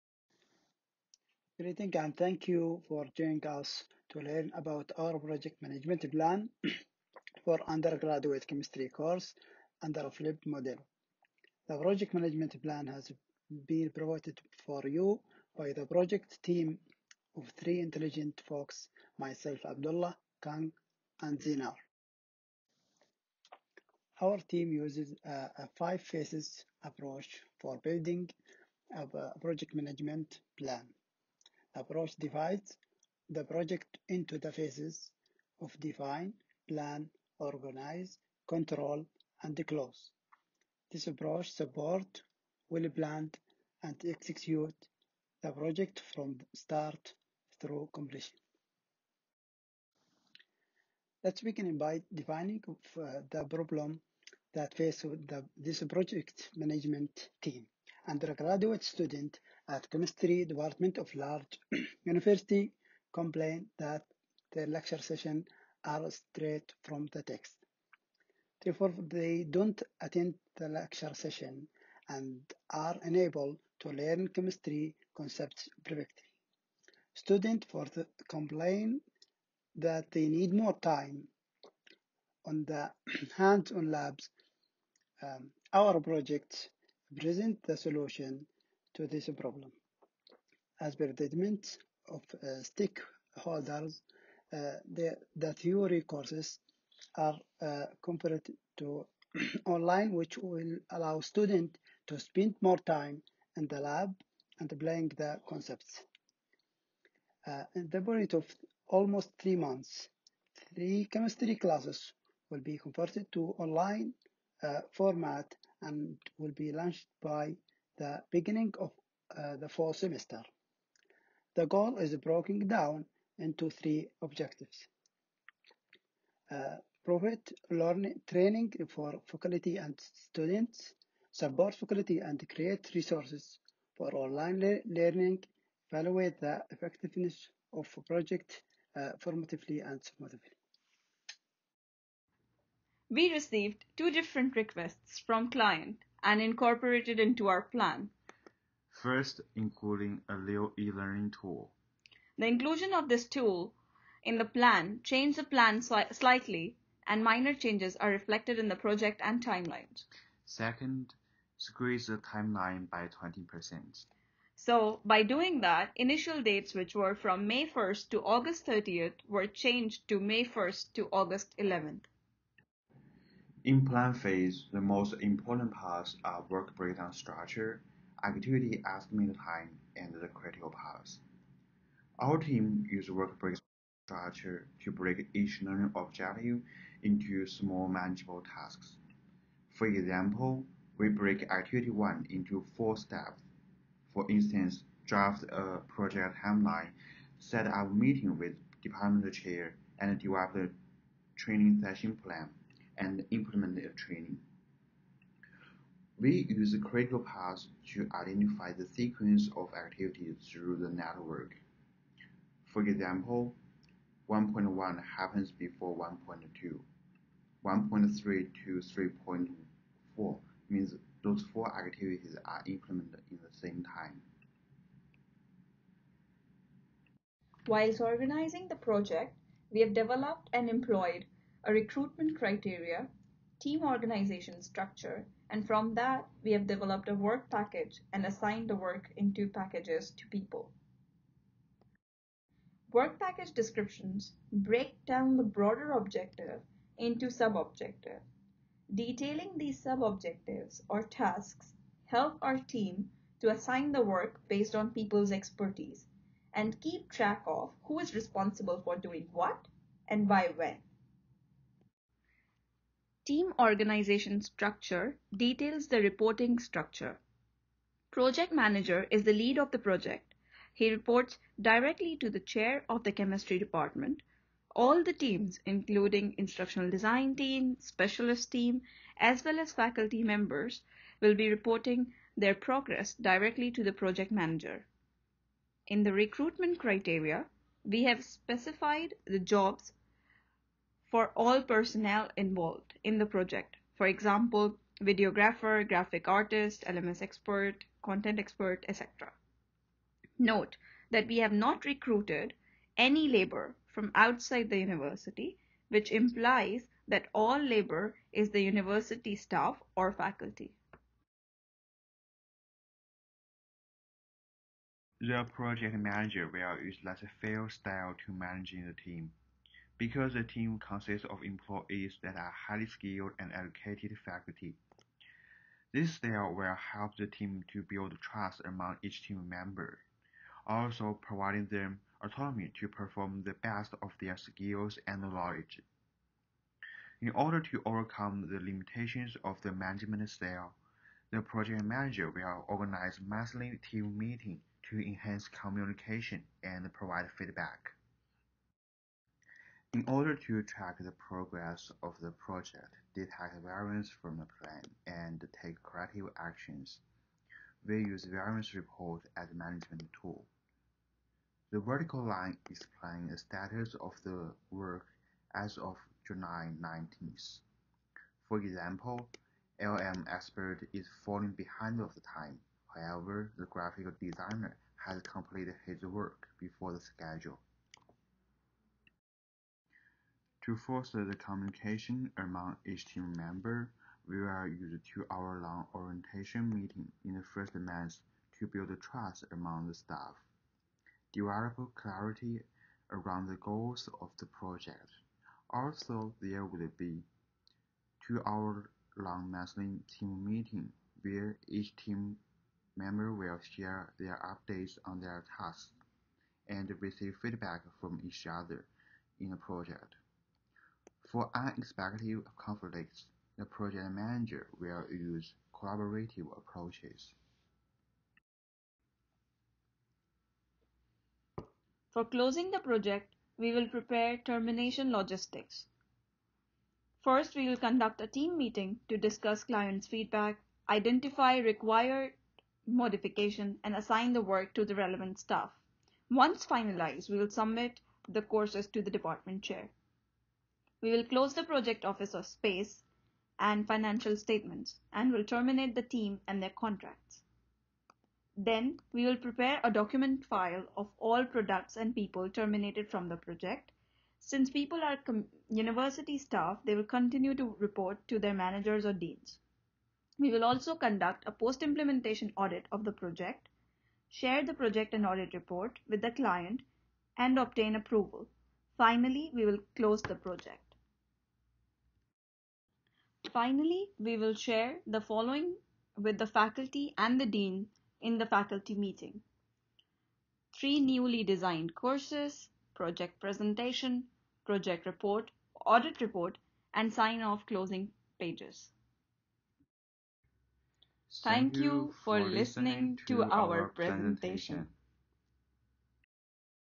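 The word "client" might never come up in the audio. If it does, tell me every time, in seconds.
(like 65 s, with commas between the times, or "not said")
145 s, 429 s, 466 s.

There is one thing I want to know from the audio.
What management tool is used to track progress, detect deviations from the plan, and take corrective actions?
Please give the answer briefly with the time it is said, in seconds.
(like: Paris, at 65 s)
variance report, at 358 s.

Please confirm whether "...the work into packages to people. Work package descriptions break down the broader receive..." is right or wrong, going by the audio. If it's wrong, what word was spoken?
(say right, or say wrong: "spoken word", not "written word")
wrong: "objective", not "receive".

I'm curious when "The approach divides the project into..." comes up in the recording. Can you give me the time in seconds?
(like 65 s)
31 s.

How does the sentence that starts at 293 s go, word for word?
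For example, videographer, graphic artist, LMS expert, content expert, etc.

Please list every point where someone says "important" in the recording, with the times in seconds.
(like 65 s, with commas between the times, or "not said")
175 s.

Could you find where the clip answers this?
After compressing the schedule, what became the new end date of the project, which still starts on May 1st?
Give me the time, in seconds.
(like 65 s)
171 s.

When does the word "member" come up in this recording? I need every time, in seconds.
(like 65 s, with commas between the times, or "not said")
280 s, 329 s, 383 s, 402 s.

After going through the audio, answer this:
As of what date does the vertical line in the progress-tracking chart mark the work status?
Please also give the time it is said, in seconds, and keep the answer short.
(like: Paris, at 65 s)
July 19, at 366 s.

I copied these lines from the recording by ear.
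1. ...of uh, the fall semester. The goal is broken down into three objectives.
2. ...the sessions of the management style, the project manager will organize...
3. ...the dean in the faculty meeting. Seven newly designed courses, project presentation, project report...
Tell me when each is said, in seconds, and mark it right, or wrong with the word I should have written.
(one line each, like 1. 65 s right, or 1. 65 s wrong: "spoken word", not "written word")
1. 118 s right
2. 338 s wrong: "limitations", not "sessions"
3. 477 s wrong: "Three", not "Seven".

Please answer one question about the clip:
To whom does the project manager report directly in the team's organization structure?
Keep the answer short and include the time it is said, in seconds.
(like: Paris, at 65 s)
chair of the chemistry department, at 272 s.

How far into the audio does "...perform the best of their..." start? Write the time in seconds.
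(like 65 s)
332 s.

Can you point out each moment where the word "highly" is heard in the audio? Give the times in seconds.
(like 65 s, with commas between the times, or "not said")
322 s.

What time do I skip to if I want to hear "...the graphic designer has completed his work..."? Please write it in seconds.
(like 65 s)
373 s.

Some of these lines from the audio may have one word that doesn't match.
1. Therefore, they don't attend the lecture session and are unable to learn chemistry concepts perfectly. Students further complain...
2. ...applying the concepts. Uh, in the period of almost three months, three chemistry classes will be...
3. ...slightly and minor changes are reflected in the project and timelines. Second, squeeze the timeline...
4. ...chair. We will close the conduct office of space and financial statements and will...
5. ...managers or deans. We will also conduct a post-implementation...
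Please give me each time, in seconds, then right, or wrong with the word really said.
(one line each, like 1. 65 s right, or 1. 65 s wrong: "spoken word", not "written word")
1. 68 s right
2. 104 s right
3. 156 s right
4. 439 s wrong: "project", not "conduct"
5. 458 s right.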